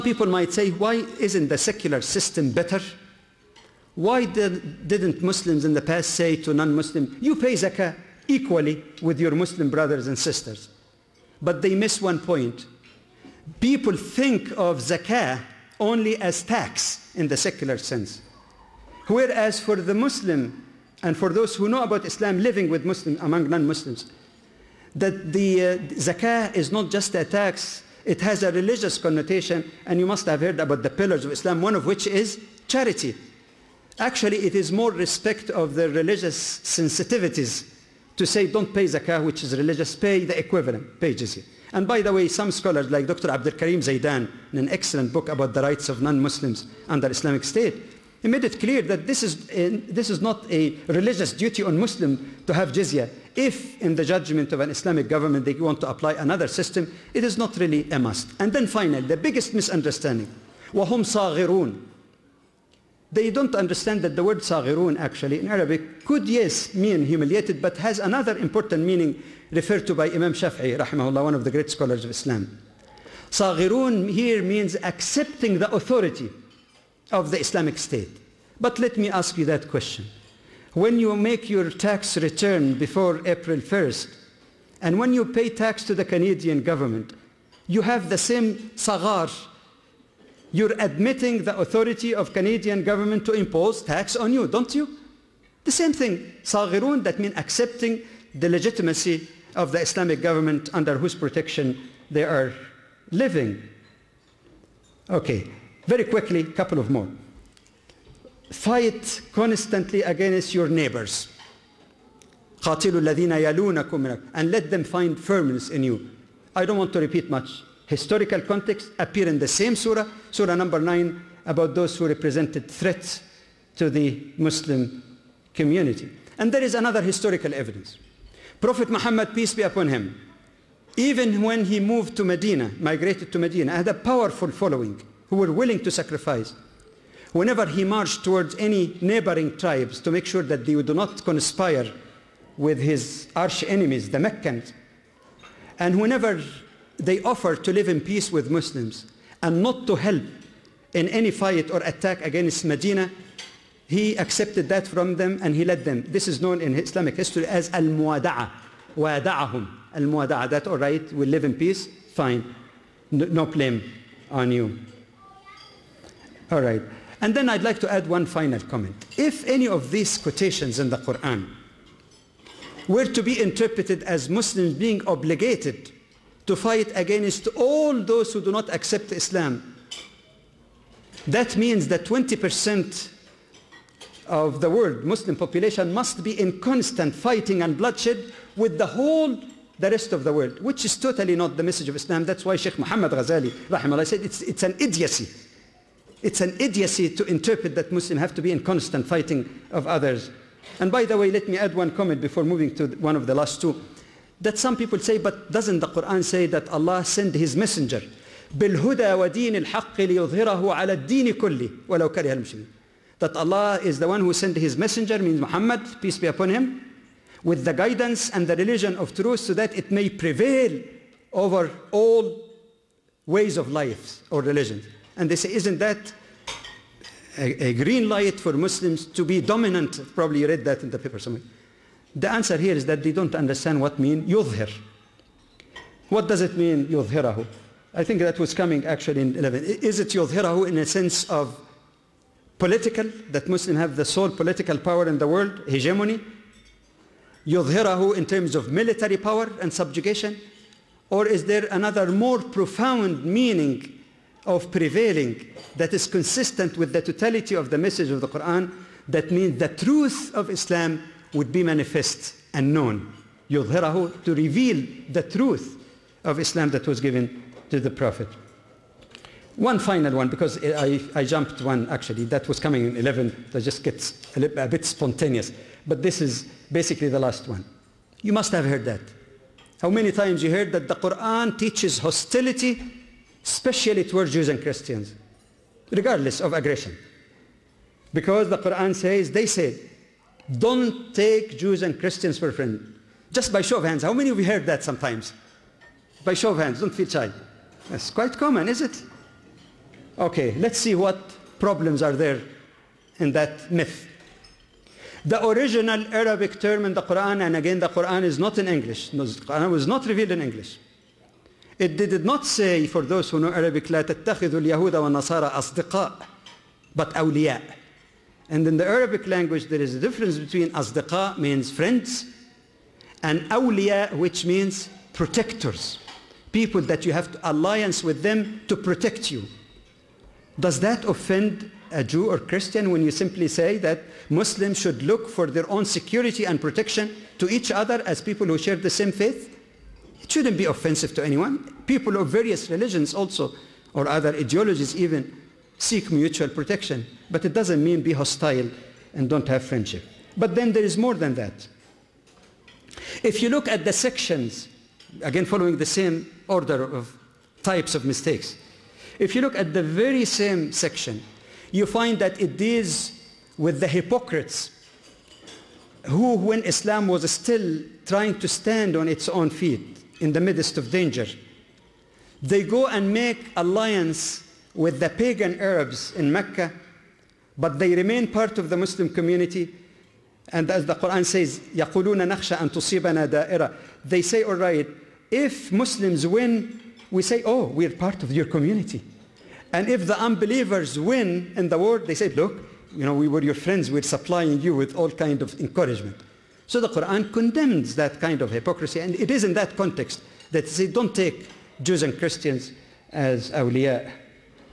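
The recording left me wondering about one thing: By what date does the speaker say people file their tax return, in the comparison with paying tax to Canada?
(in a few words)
April 1st.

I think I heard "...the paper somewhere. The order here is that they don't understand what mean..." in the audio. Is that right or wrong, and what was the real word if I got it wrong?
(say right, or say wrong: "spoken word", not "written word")
wrong: "answer", not "order".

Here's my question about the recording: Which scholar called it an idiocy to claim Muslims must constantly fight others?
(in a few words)
Sheikh Muhammad Ghazali.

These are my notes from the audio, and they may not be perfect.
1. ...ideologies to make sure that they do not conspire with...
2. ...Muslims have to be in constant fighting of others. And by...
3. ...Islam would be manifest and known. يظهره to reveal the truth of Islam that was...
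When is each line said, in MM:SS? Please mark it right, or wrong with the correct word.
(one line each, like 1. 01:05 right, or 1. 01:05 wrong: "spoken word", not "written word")
1. 02:19 wrong: "tribes", not "ideologies"
2. 03:17 right
3. 04:20 right.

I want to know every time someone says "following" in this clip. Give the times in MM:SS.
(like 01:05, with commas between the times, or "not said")
02:14, 05:55.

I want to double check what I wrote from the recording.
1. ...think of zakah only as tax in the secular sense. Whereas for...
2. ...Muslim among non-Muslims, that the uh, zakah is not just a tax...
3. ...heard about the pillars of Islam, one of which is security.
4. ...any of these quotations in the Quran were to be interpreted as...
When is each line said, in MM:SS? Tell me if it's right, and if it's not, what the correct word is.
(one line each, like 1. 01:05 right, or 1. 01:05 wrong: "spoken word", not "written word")
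1. 00:13 right
2. 00:22 right
3. 00:30 wrong: "charity", not "security"
4. 02:49 right.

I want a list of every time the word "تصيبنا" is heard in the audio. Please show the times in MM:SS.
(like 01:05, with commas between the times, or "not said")
06:22.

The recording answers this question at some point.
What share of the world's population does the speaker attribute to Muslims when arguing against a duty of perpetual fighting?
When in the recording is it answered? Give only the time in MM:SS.
03:02.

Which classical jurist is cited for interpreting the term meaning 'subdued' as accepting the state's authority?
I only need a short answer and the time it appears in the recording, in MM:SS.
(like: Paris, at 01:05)
Imam Shafi'i, at 01:10.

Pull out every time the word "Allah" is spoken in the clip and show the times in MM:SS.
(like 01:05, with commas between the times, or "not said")
03:26, 03:33.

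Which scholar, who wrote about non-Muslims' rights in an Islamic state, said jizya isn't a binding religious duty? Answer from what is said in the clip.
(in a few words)
Dr. Abdul Karim Zaidan.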